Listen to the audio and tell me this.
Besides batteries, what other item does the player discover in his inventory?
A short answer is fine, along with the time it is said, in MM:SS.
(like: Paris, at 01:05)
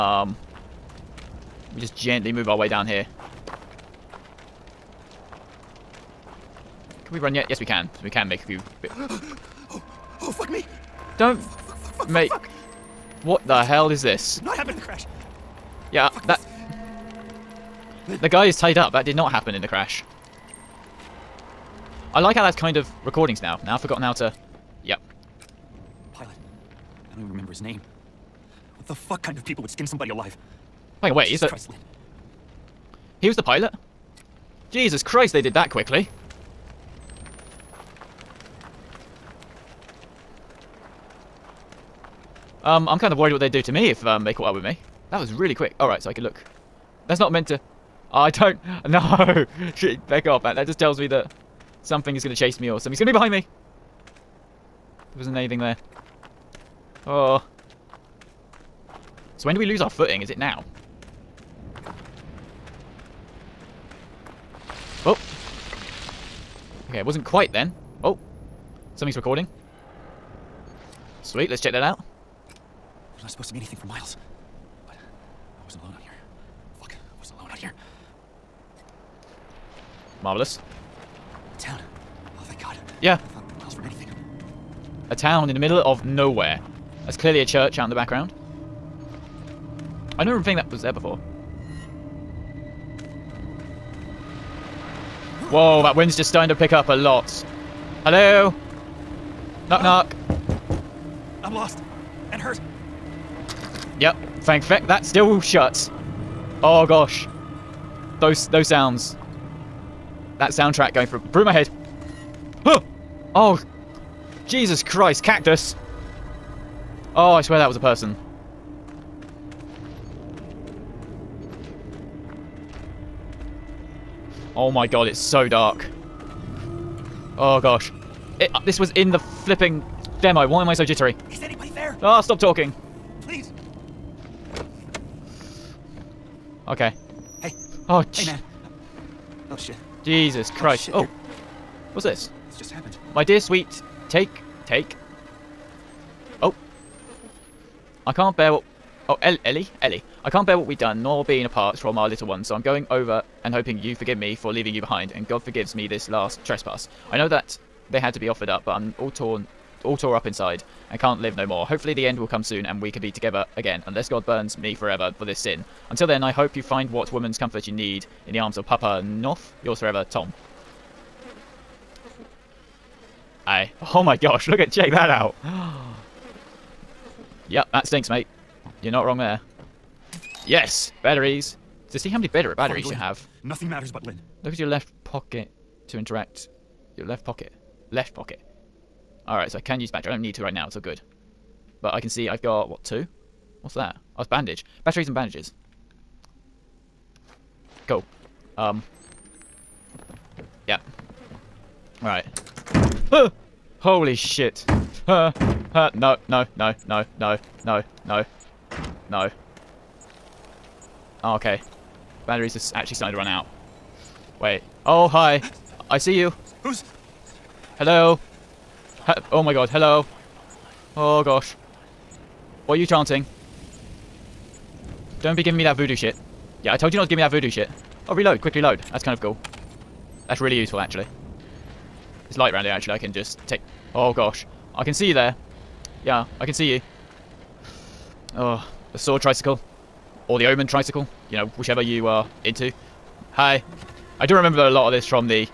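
Bandage, at 03:14.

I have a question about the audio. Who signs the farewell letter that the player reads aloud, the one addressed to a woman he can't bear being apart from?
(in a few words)
Tom.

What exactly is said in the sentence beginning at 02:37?
I know that they had to be offered up, but I'm all torn, all tore up inside and can't live no more.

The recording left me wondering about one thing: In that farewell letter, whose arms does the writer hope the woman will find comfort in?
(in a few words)
Papa Knoth.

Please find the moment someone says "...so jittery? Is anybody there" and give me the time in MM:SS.
02:10.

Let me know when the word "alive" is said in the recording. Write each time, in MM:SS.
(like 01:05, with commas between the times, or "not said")
00:30.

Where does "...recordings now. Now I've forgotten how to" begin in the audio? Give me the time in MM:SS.
00:23.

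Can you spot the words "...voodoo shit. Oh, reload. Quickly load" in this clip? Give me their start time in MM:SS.
03:47.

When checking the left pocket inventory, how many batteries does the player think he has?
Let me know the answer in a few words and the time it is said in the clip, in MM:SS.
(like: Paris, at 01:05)
2, at 03:12.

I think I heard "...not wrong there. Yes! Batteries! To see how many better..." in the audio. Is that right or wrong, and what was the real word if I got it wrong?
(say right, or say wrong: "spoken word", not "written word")
right.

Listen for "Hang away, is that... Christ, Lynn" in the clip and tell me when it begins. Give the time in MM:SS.
00:31.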